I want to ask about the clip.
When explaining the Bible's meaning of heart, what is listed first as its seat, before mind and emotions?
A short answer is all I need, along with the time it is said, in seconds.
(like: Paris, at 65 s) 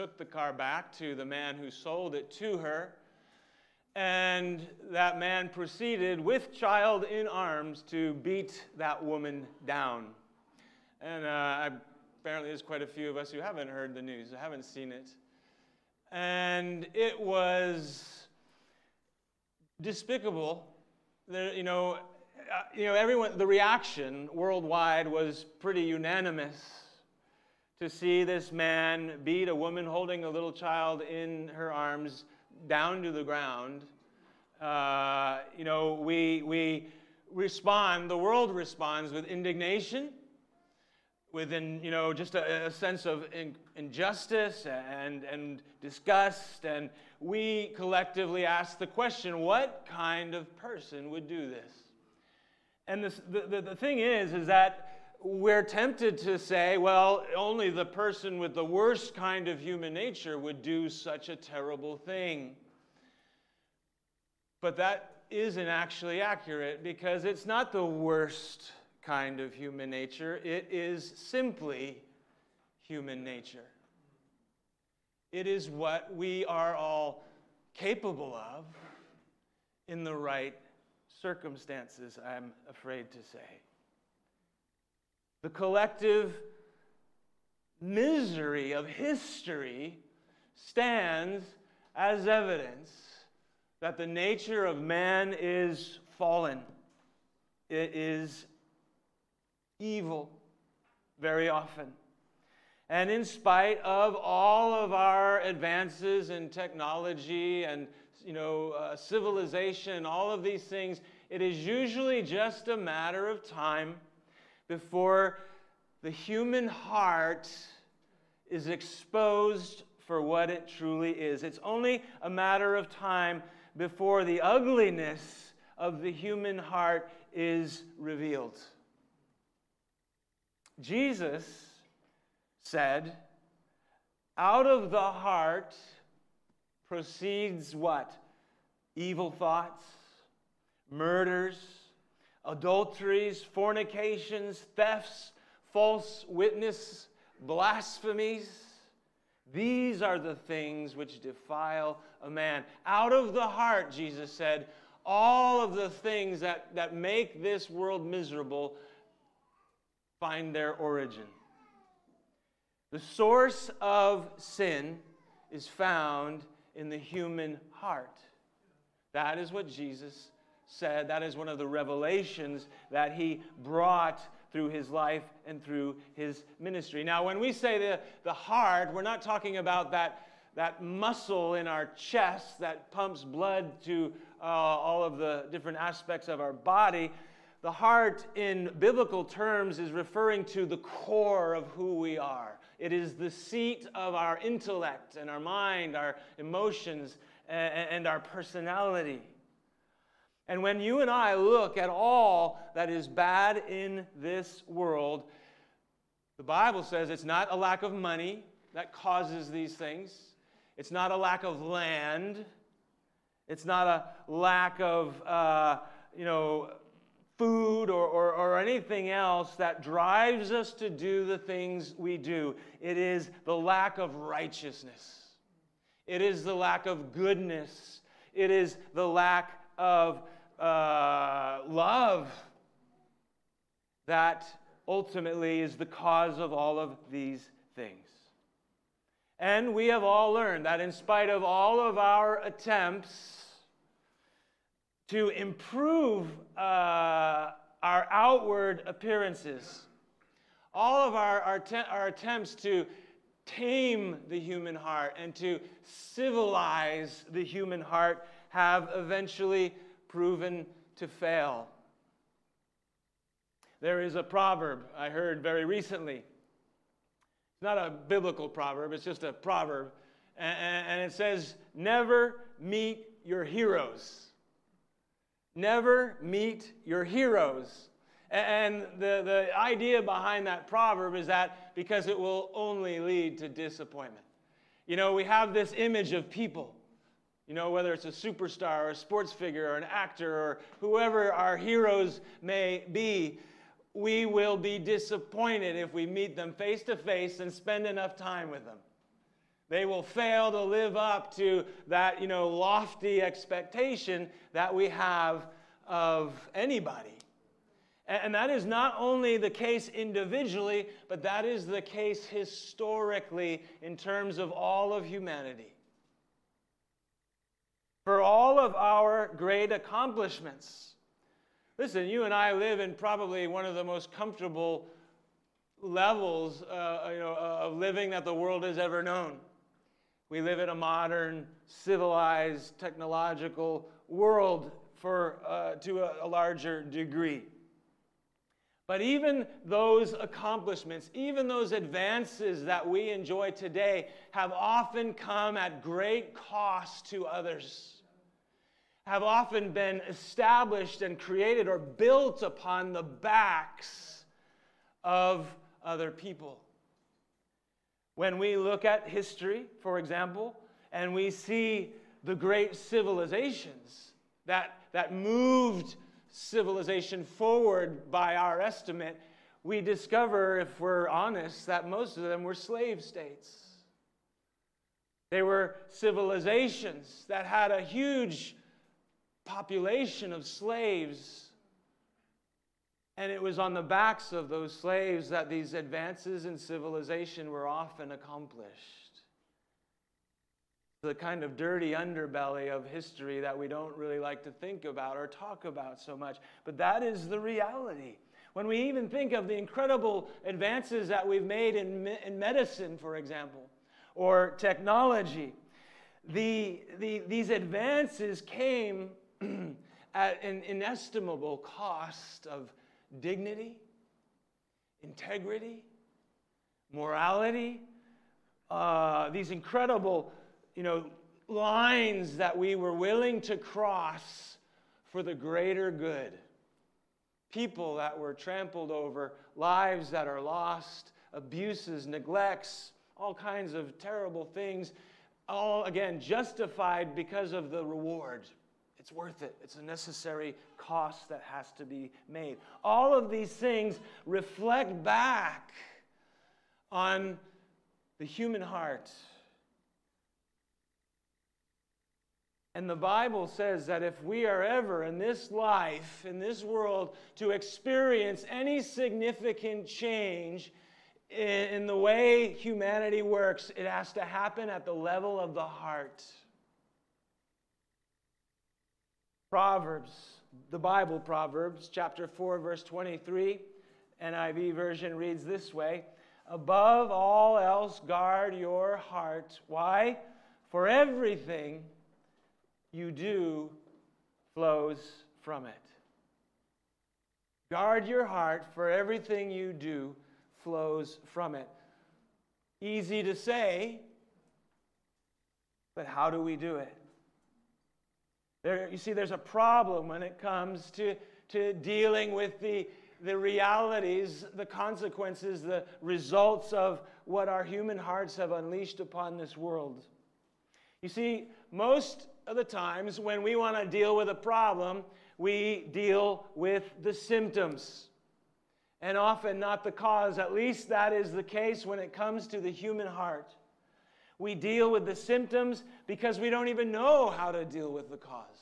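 intellect, at 194 s.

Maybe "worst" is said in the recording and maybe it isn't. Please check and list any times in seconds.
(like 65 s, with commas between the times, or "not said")
58 s, 67 s.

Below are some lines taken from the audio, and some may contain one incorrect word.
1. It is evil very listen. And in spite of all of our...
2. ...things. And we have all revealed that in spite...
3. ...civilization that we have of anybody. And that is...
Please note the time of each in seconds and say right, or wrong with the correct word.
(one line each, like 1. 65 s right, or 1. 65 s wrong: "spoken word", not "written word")
1. 97 s wrong: "often", not "listen"
2. 237 s wrong: "learned", not "revealed"
3. 303 s wrong: "expectation", not "civilization".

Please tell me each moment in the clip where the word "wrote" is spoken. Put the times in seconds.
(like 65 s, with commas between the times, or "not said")
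not said.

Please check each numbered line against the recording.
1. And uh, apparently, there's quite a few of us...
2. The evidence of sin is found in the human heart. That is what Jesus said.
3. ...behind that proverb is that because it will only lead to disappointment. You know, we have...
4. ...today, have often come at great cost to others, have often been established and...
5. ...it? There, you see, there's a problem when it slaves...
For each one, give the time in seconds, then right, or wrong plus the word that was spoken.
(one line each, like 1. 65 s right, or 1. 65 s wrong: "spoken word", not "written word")
1. 11 s right
2. 162 s wrong: "source", not "evidence"
3. 280 s right
4. 343 s right
5. 496 s wrong: "comes", not "slaves".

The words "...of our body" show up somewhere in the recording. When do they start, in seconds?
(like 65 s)
186 s.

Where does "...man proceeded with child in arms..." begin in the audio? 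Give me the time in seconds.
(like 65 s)
5 s.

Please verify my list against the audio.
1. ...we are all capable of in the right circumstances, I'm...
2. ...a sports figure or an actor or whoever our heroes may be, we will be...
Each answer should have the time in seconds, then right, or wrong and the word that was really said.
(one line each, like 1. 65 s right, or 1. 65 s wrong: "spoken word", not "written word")
1. 76 s right
2. 288 s right.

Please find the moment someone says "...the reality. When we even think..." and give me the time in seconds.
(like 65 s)
397 s.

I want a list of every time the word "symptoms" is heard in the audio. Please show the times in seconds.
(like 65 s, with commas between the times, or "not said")
517 s, 525 s.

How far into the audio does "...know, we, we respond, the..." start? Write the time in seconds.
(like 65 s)
35 s.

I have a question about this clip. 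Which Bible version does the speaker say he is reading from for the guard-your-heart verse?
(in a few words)
NIV.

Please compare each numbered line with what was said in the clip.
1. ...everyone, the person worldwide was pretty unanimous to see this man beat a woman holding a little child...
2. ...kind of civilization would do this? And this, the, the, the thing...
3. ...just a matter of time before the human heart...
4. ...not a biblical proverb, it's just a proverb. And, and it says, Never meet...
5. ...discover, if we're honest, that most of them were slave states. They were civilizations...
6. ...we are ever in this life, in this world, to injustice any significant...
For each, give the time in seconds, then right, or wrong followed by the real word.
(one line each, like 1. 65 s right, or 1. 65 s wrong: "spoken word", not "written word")
1. 22 s wrong: "reaction", not "person"
2. 49 s wrong: "person", not "civilization"
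3. 112 s right
4. 267 s right
5. 369 s right
6. 454 s wrong: "experience", not "injustice".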